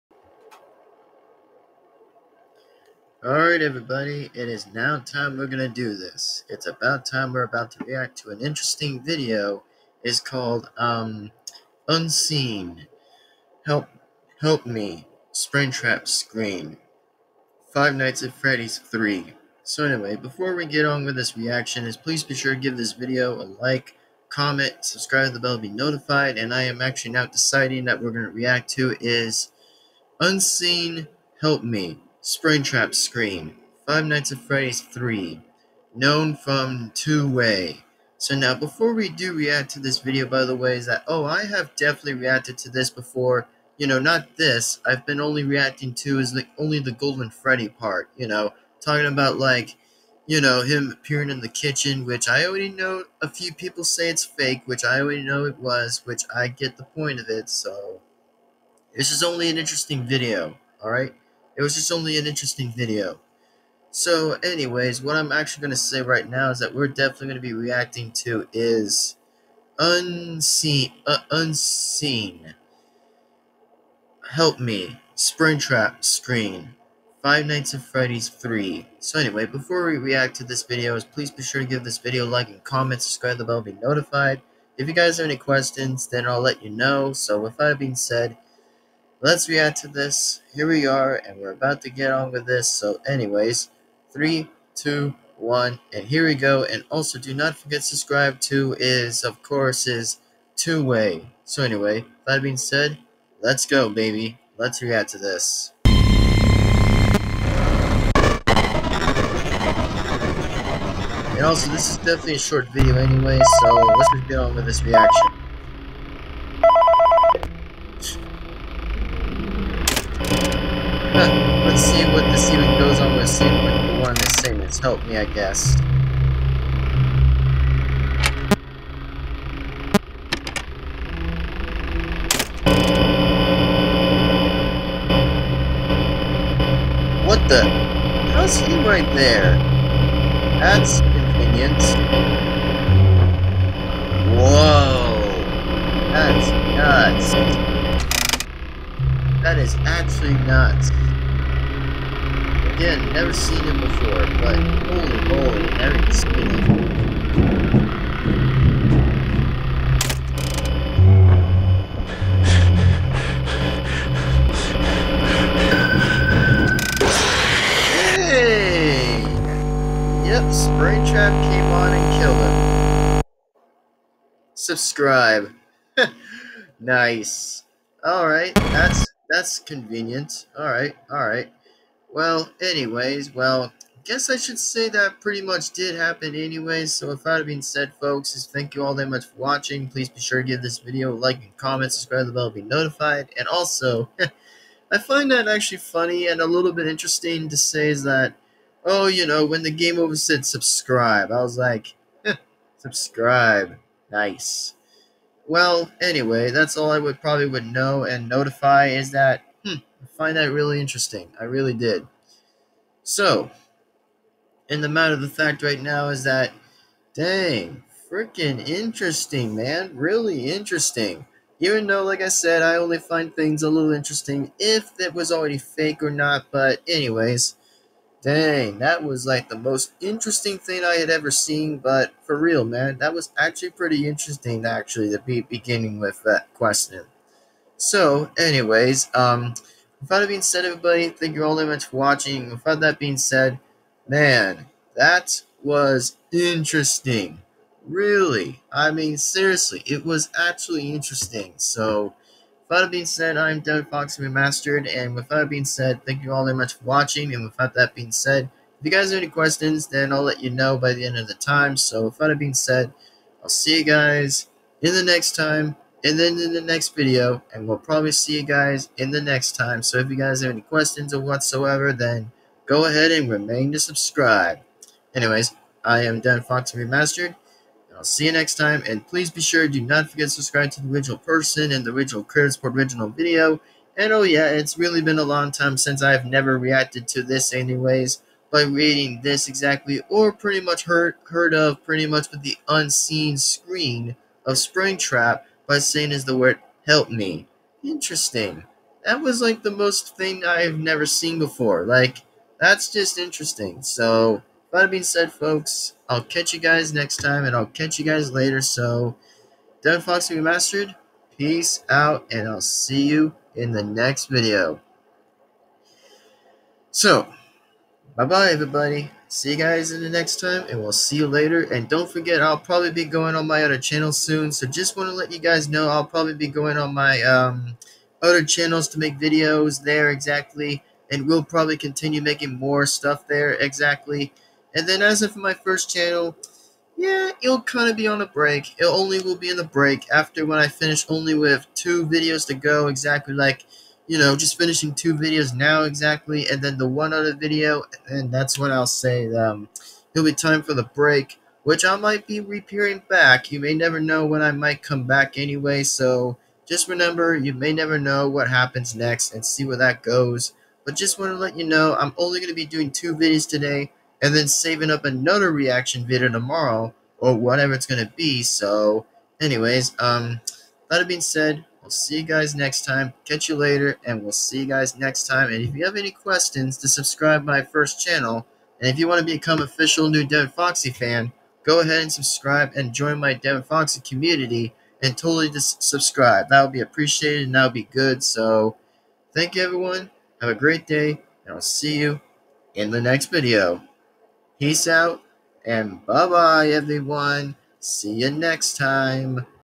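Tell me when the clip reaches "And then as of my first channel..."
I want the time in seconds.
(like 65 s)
334 s.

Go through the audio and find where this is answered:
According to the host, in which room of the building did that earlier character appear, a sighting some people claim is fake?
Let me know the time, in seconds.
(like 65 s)
51 s.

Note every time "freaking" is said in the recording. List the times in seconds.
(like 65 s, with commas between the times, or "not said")
218 s.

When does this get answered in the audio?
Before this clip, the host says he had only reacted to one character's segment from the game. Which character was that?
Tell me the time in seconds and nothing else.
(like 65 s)
46 s.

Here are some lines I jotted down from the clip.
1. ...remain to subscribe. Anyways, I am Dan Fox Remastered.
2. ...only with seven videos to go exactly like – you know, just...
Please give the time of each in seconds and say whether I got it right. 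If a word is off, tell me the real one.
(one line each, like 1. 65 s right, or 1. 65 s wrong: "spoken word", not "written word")
1. 273 s right
2. 341 s wrong: "two", not "seven".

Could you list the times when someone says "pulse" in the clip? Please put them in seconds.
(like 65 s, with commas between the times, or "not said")
not said.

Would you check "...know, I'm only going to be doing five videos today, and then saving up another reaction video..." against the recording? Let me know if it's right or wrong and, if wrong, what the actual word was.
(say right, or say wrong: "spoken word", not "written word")
wrong: "two", not "five".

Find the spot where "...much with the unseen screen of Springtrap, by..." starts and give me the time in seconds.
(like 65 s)
292 s.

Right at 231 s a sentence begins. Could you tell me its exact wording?
But for real, man, that was actually pretty interesting, actually, to be beginning with that question.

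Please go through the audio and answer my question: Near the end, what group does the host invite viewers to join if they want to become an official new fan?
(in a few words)
Devin Foxy community.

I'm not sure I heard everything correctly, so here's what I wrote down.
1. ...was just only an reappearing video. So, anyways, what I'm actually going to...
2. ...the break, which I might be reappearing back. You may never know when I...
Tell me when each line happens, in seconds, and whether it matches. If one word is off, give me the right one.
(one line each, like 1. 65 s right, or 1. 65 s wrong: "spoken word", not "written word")
1. 61 s wrong: "interesting", not "reappearing"
2. 350 s right.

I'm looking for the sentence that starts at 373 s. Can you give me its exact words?
Catch you later, and we'll see you guys next time.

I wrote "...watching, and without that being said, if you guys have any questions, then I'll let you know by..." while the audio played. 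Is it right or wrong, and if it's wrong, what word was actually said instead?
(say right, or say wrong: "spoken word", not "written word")
right.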